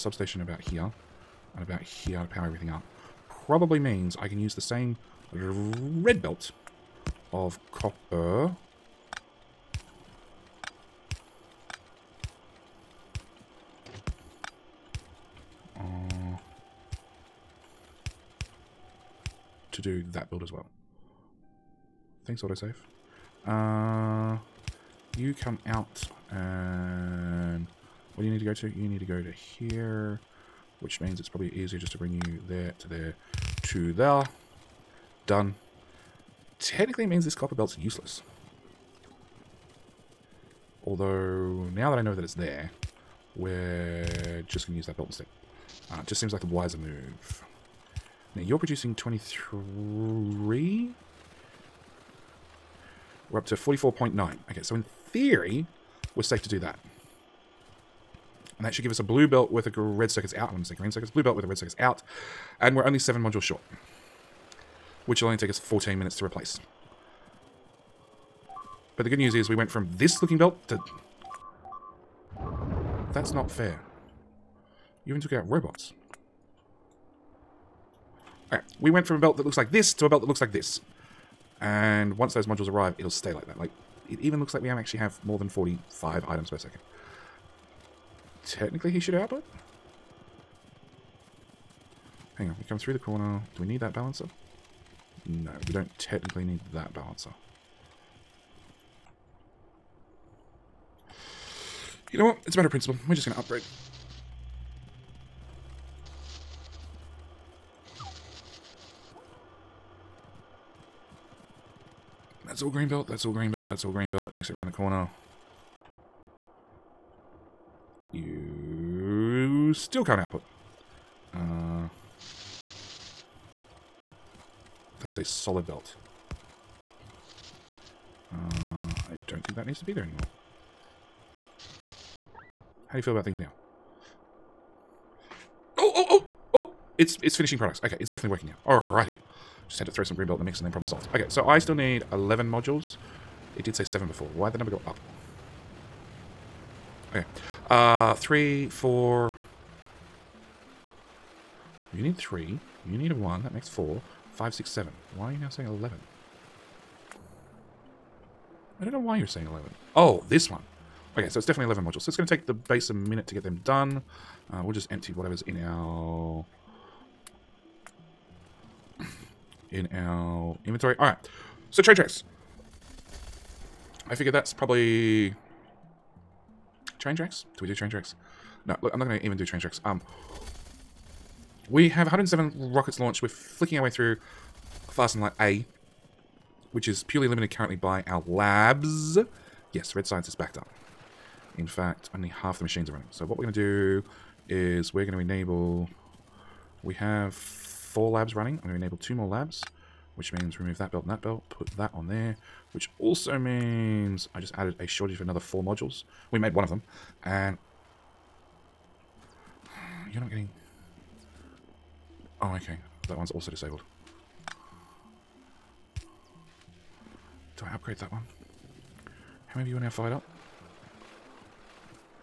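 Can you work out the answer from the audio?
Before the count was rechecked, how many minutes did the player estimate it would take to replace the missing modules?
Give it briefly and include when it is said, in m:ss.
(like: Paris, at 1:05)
14, at 1:05.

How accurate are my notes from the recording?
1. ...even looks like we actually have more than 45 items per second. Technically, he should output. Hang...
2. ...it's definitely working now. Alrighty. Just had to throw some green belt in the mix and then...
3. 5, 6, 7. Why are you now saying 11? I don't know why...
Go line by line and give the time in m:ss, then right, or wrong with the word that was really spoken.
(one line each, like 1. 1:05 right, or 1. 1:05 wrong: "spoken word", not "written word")
1. 1:24 right
2. 2:17 right
3. 2:34 right.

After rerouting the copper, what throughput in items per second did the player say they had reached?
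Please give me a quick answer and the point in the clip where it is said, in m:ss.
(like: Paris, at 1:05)
44.9, at 0:53.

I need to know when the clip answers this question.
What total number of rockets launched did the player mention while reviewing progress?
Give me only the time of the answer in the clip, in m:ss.
3:02.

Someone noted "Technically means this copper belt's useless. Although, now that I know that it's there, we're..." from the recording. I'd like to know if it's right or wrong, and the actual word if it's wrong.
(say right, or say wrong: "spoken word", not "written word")
right.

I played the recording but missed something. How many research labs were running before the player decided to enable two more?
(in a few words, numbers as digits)
4.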